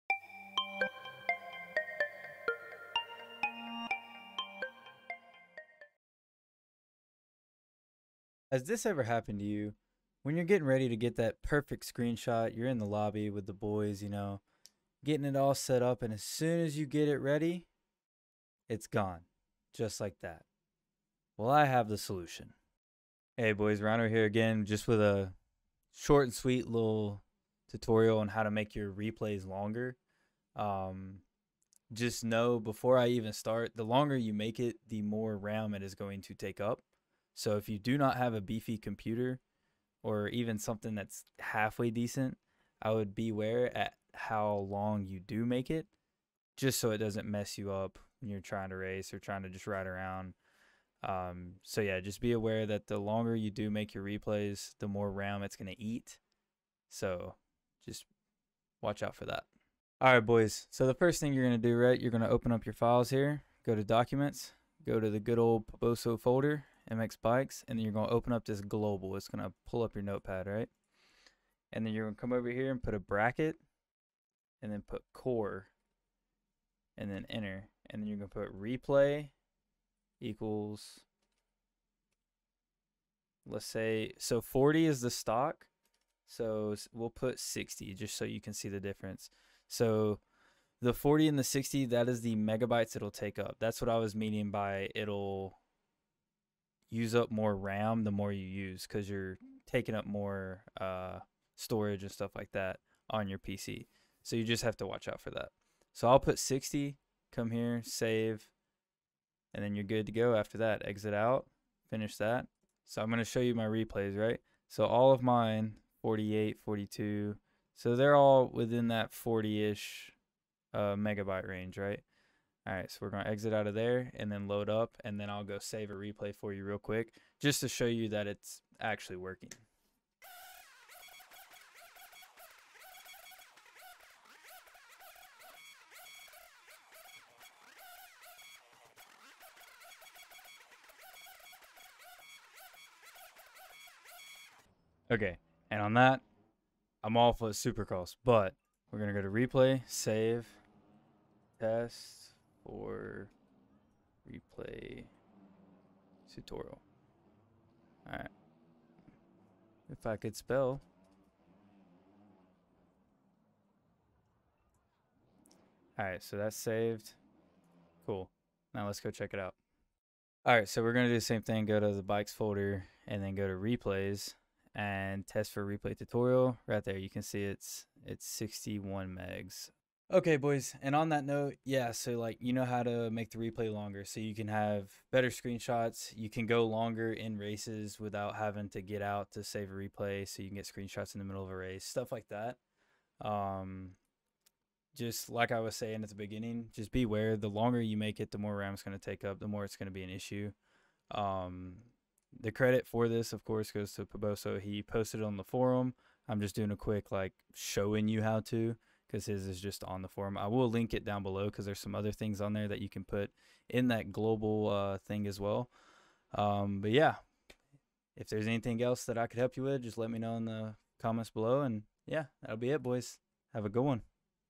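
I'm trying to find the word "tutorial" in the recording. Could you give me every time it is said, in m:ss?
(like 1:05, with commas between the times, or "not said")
0:27, 2:36, 2:55.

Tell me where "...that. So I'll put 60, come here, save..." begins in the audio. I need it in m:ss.
1:45.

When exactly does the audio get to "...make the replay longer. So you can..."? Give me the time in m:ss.
3:03.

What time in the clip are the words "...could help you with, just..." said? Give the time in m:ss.
3:39.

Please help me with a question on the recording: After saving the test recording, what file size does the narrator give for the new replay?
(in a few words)
61 megabytes.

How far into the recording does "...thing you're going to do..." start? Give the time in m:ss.
1:01.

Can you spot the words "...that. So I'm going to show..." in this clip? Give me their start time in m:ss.
1:52.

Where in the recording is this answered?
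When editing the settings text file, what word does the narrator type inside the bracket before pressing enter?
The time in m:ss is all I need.
1:15.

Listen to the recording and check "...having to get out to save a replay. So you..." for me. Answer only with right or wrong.
right.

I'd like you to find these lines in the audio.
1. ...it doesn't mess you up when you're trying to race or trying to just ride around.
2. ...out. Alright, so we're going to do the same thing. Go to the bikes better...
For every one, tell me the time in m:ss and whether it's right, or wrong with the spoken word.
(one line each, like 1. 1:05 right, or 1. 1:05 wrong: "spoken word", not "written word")
1. 0:46 right
2. 2:49 wrong: "folder", not "better".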